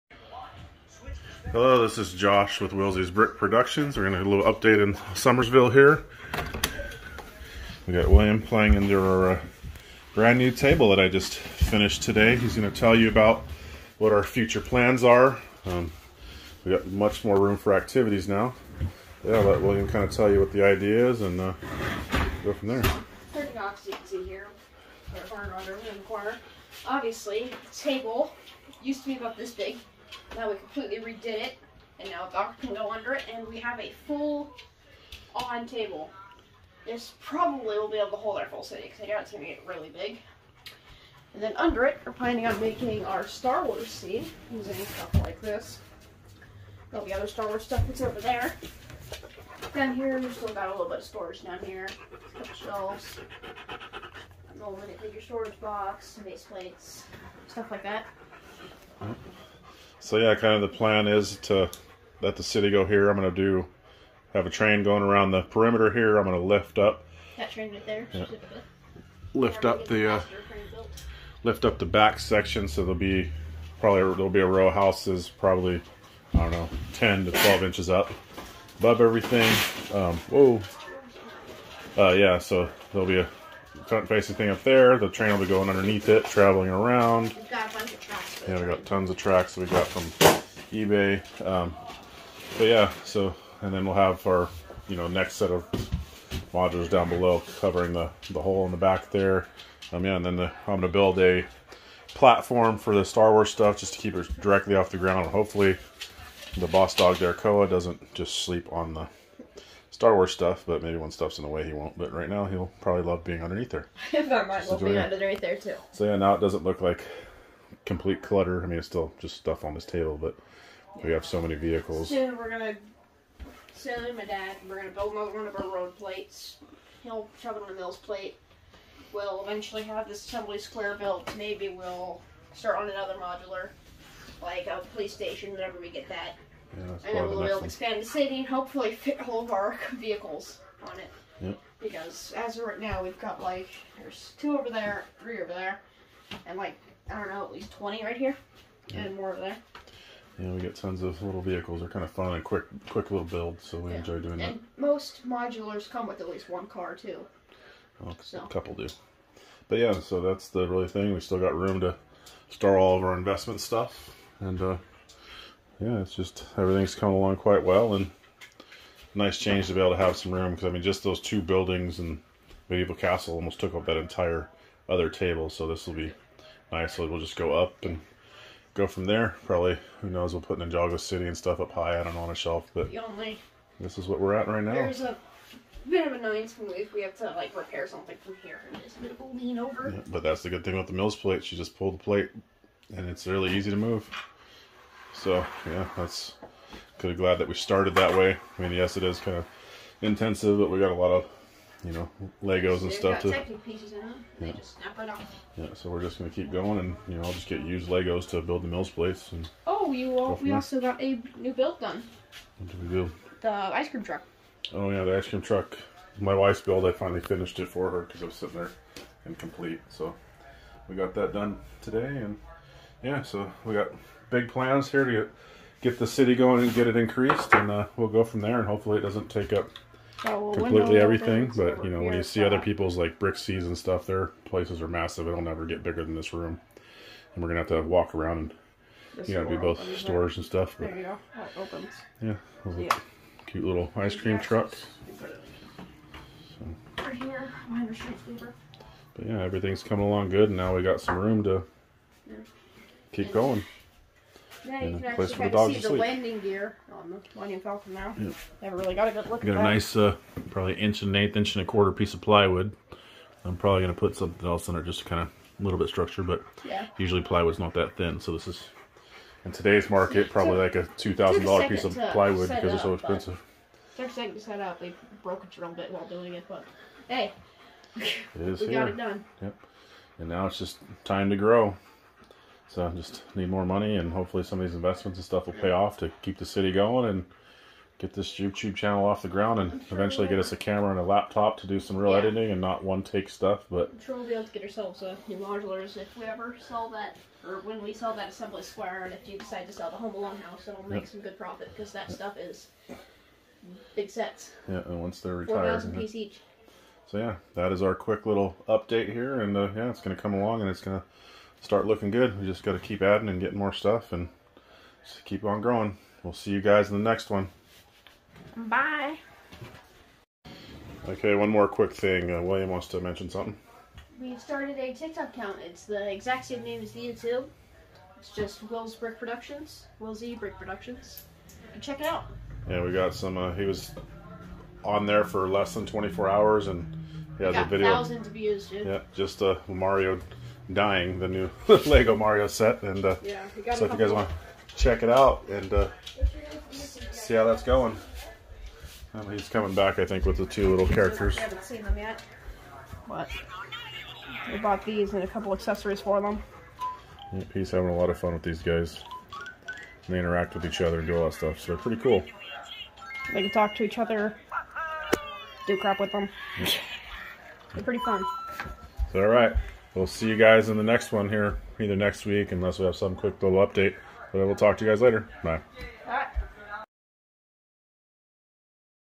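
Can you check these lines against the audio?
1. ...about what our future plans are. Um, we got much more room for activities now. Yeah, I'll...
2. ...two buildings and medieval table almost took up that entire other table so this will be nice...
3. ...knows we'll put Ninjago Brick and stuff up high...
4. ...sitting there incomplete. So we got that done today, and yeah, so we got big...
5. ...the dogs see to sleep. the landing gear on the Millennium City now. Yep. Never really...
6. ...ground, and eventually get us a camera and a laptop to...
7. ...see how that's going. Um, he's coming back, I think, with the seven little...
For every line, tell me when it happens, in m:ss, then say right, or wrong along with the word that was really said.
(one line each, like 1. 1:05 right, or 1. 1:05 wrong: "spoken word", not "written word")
1. 0:13 right
2. 2:51 wrong: "castle", not "table"
3. 3:00 wrong: "City", not "Brick"
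4. 3:38 right
5. 4:15 wrong: "Falcon", not "City"
6. 4:49 right
7. 5:47 wrong: "two", not "seven".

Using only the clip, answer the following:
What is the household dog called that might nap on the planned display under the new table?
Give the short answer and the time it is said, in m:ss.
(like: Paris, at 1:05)
Koa, at 1:47.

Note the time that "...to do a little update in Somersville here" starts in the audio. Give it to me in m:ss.
0:04.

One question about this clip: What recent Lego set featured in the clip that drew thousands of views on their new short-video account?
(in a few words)
Lego Mario.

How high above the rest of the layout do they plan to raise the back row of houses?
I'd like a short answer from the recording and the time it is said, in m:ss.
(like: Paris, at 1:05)
10 to 12 inches, at 1:16.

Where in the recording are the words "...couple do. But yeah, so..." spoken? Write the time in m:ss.
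2:38.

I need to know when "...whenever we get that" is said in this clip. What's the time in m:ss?
2:15.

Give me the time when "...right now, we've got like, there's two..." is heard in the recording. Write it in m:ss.
2:22.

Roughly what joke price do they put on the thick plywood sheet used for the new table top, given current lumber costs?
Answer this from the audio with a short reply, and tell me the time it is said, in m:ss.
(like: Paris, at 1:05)
$2,000, at 4:30.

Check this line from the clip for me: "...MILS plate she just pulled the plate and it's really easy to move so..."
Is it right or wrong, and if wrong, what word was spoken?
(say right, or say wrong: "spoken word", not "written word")
right.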